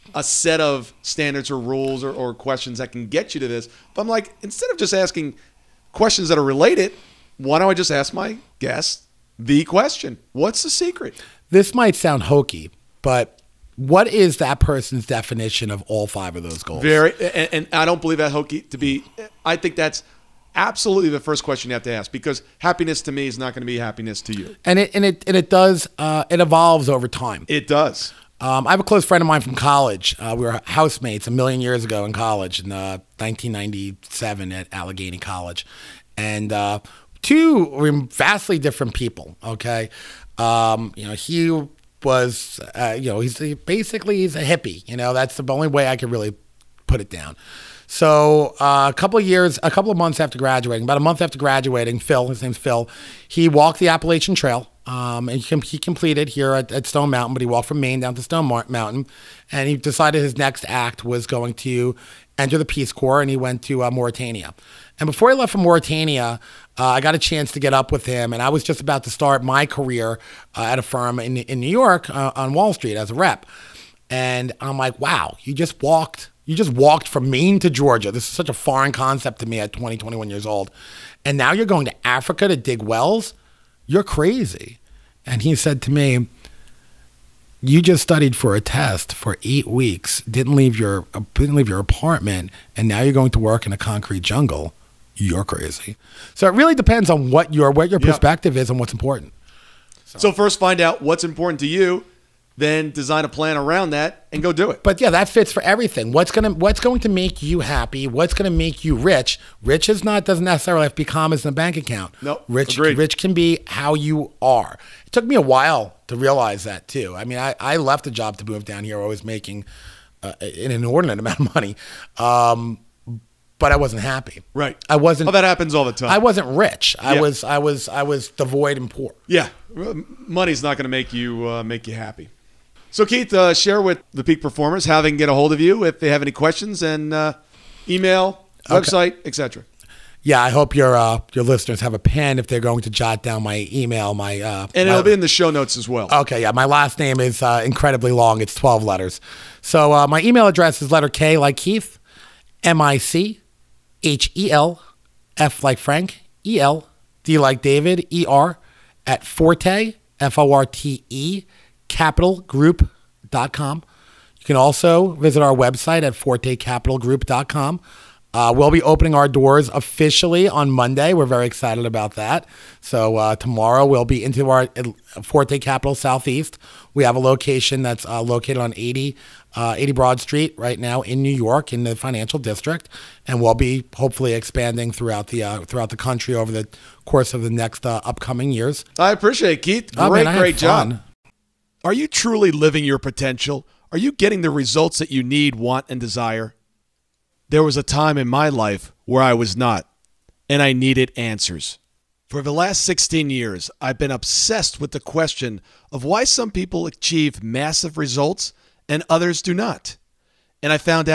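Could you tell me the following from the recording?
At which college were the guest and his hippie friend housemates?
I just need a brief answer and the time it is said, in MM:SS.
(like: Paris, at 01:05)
Allegheny College, at 00:34.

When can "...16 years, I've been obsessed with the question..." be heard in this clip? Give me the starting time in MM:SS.
03:22.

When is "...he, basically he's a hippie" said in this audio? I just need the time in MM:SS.
00:43.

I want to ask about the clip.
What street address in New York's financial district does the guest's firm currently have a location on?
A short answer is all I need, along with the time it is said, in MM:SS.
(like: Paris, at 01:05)
80 Broad Street, at 02:59.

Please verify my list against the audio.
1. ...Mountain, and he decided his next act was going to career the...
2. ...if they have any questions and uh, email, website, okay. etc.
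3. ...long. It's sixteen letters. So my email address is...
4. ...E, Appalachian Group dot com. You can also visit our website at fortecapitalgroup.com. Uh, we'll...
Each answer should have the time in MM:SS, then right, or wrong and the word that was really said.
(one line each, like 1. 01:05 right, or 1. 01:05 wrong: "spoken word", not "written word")
1. 00:58 wrong: "enter", not "career"
2. 02:15 right
3. 02:28 wrong: "twelve", not "sixteen"
4. 02:41 wrong: "Capital", not "Appalachian".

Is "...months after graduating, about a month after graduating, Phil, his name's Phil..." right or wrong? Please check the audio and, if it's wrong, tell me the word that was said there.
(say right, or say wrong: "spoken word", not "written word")
right.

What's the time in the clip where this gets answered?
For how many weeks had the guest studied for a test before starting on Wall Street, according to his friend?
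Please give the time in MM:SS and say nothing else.
01:29.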